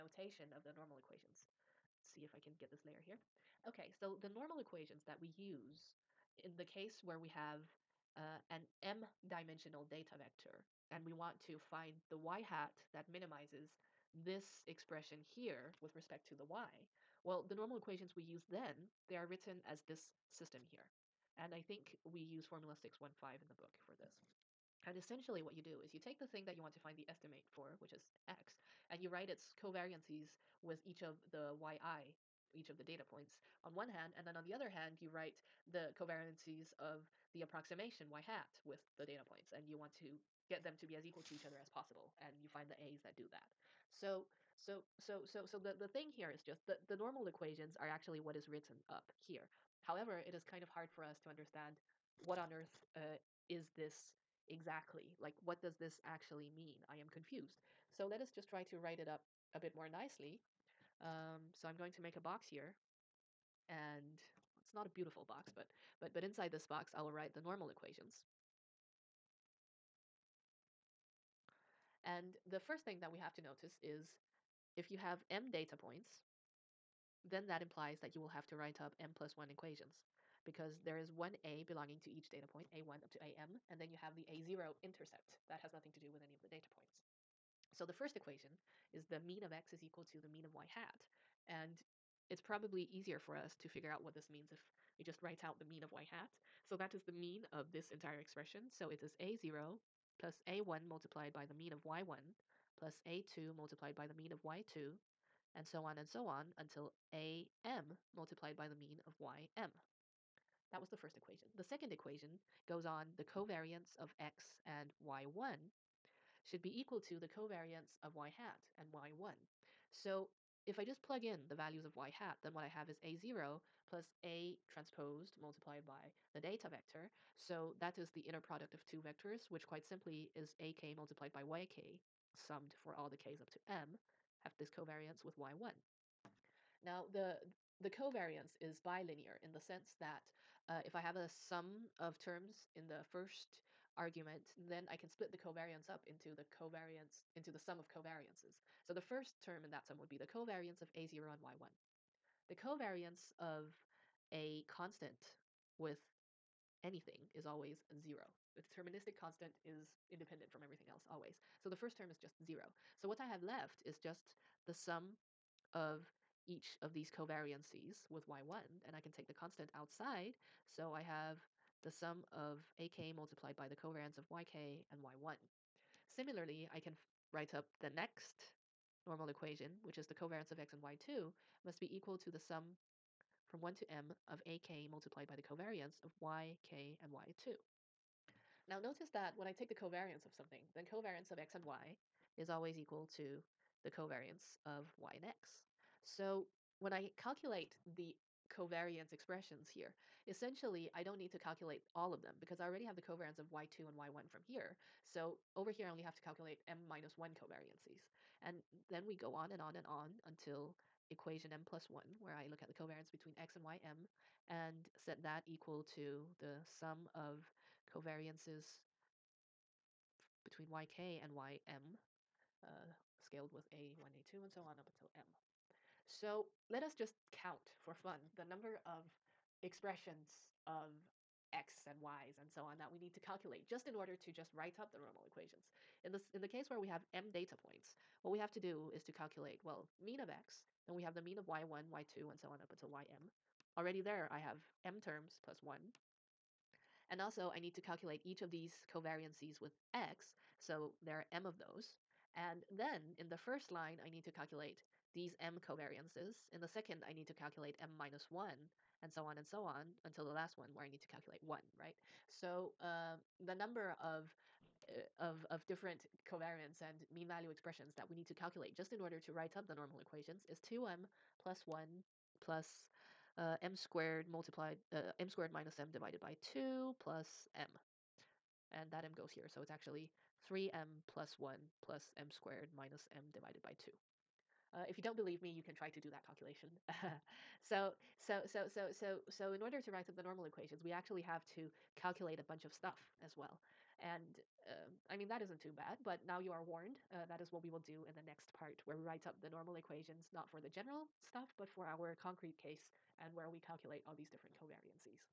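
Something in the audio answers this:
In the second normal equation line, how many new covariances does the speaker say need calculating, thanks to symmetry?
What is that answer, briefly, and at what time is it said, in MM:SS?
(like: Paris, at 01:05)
m minus 1, at 03:26.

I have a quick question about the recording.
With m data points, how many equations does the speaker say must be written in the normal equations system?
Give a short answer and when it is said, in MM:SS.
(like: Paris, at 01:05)
m plus 1, at 01:18.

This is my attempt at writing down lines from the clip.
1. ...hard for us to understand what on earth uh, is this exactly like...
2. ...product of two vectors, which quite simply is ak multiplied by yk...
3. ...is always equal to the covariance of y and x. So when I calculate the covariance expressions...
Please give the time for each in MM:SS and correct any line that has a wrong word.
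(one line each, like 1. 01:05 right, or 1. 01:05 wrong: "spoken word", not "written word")
1. 00:50 right
2. 02:08 right
3. 03:12 right.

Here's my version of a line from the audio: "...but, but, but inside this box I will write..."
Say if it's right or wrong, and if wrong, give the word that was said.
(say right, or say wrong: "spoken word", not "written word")
right.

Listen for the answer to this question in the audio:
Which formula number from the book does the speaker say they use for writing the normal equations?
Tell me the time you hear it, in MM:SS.
00:22.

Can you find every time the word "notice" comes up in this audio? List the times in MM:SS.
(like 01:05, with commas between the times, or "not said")
01:13, 03:08.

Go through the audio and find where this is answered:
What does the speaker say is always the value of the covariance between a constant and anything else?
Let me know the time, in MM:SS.
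02:37.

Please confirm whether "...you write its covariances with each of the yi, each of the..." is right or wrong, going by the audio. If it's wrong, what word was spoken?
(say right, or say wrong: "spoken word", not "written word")
right.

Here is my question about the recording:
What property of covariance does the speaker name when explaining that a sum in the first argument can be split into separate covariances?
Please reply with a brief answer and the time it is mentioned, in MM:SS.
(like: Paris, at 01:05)
bilinear, at 02:18.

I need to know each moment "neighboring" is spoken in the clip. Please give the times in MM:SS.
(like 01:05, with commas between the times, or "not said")
not said.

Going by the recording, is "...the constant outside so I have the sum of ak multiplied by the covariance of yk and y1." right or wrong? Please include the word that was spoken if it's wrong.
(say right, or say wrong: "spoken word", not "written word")
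right.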